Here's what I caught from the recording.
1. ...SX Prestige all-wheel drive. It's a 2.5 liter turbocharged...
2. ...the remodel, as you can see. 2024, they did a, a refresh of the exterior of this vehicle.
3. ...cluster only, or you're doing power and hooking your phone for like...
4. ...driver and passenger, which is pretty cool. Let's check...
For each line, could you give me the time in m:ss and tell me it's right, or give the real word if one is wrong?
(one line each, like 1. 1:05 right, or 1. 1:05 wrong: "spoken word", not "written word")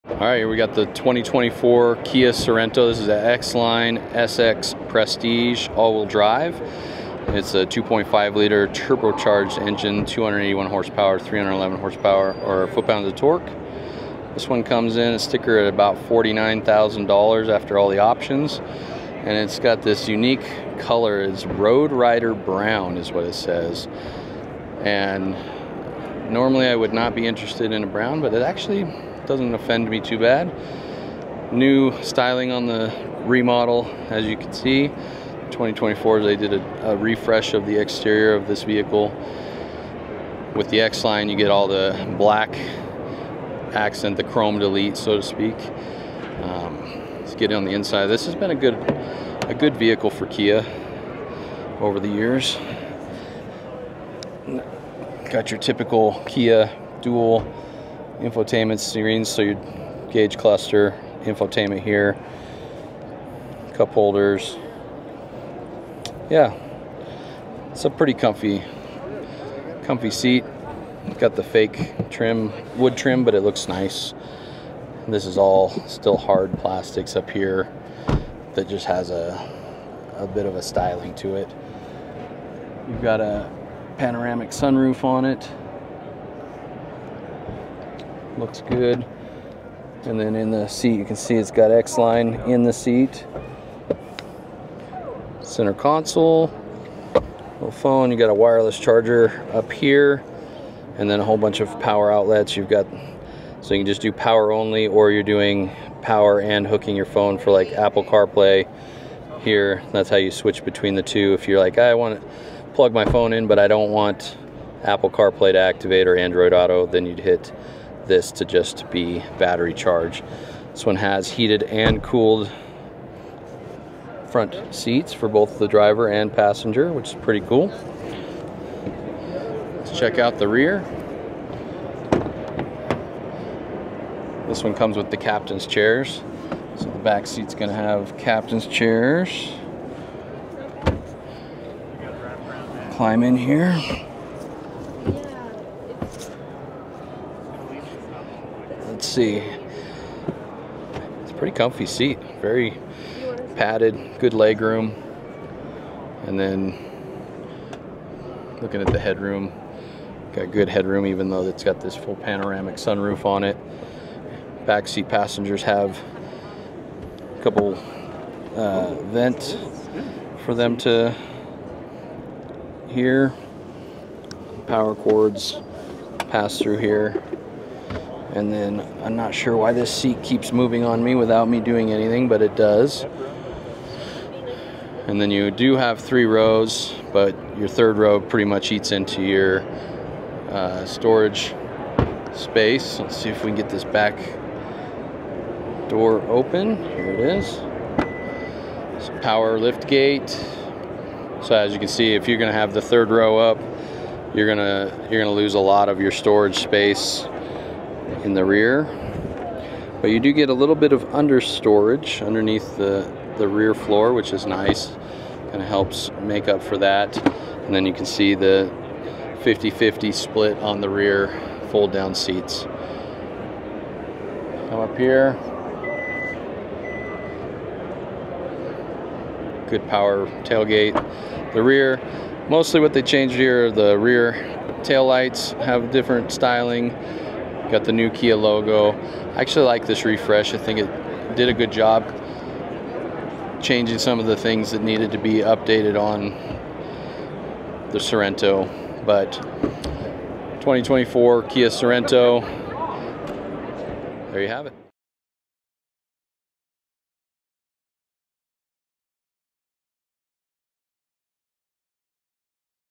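1. 0:04 right
2. 0:32 right
3. 1:44 wrong: "power", not "cluster"
4. 2:05 right.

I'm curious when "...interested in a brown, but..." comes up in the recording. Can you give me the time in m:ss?
0:27.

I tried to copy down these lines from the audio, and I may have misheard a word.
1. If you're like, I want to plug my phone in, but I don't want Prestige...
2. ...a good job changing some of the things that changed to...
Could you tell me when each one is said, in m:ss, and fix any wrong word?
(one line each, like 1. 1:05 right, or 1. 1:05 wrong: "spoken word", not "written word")
1. 1:51 wrong: "Apple", not "Prestige"
2. 4:01 wrong: "needed", not "changed".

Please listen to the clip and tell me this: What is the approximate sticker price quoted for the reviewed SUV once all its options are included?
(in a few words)
$49,000.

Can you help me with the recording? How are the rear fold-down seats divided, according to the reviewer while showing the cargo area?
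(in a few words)
50-50 split.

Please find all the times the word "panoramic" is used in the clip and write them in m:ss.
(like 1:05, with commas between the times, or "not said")
1:23, 2:42.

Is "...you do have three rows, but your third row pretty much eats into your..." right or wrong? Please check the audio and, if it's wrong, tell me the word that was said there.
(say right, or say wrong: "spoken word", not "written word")
right.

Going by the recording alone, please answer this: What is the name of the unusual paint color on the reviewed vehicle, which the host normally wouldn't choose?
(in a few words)
Road Rider Brown.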